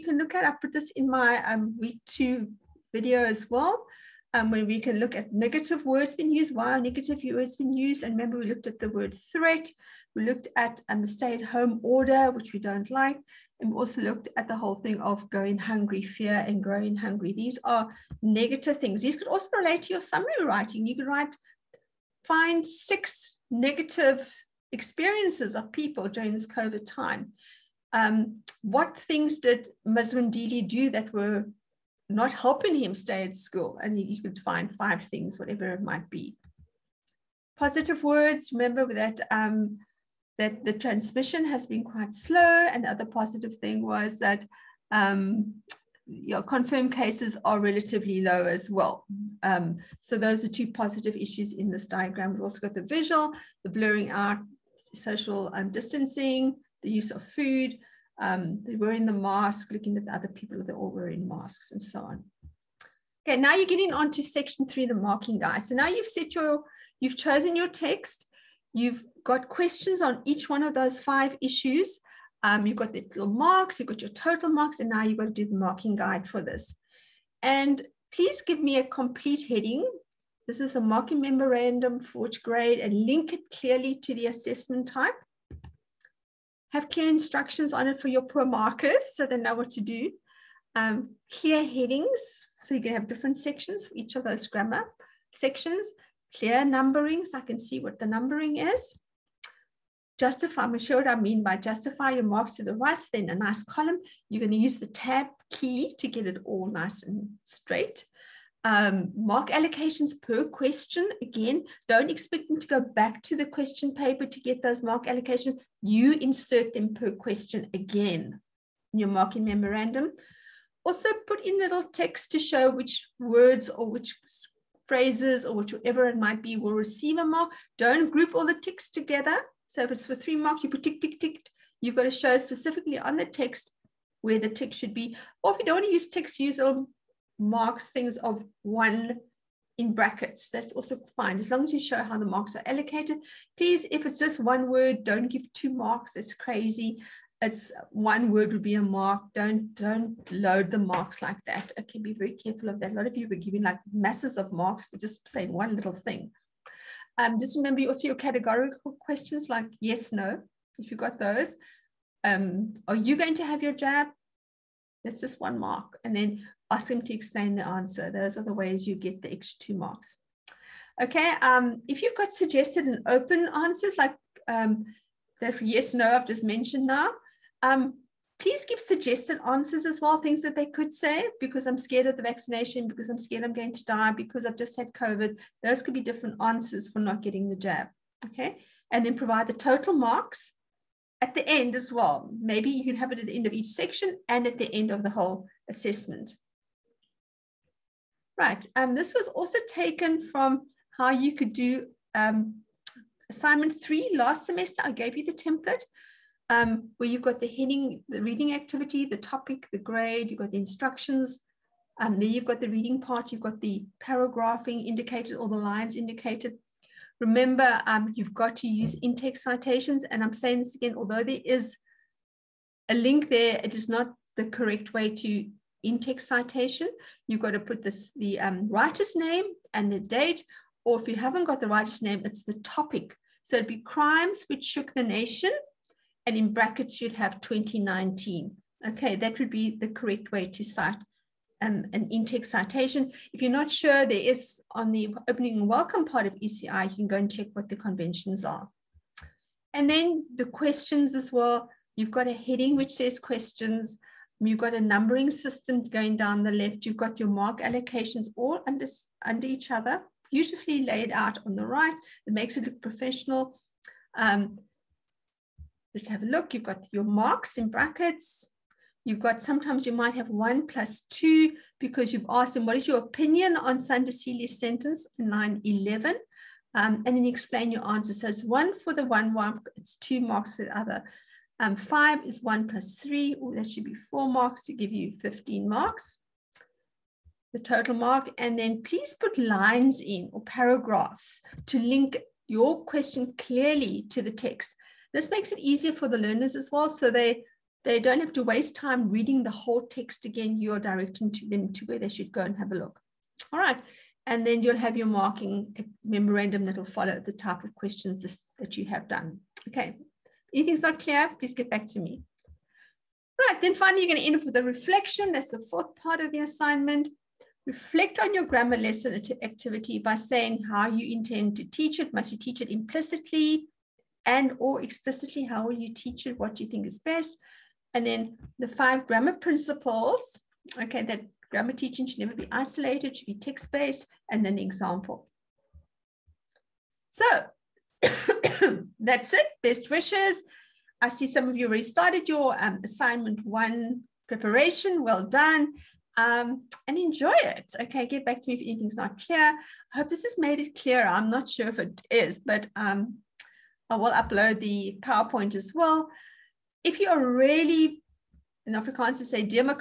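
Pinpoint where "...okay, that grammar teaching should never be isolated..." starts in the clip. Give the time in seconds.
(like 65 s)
330 s.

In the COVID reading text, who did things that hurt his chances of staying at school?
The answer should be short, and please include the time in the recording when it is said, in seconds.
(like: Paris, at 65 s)
Mazwindili, at 29 s.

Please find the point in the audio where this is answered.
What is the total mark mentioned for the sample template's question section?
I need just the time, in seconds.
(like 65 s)
285 s.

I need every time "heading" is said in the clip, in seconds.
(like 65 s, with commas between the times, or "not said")
79 s, 91 s, 207 s, 252 s.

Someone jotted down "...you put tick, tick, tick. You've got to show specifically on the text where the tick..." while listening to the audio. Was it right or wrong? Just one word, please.
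right.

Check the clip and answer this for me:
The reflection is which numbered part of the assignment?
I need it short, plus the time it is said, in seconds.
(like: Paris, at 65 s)
Fourth, at 315 s.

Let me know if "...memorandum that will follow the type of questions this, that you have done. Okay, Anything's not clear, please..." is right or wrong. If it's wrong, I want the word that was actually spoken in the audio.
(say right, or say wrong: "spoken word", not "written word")
right.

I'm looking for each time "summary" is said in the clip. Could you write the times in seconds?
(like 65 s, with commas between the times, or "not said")
20 s.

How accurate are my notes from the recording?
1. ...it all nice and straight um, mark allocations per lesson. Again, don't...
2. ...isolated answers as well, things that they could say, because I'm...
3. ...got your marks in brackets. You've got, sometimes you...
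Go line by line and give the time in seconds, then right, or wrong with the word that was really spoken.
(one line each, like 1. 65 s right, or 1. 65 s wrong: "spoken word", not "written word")
1. 106 s wrong: "question", not "lesson"
2. 178 s wrong: "suggested", not "isolated"
3. 266 s right.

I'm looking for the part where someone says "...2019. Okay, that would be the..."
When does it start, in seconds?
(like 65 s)
237 s.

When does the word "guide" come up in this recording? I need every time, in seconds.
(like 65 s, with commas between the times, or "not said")
65 s, 75 s.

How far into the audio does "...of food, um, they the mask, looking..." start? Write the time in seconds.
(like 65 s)
57 s.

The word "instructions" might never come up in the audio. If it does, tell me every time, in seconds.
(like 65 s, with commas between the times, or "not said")
87 s, 210 s.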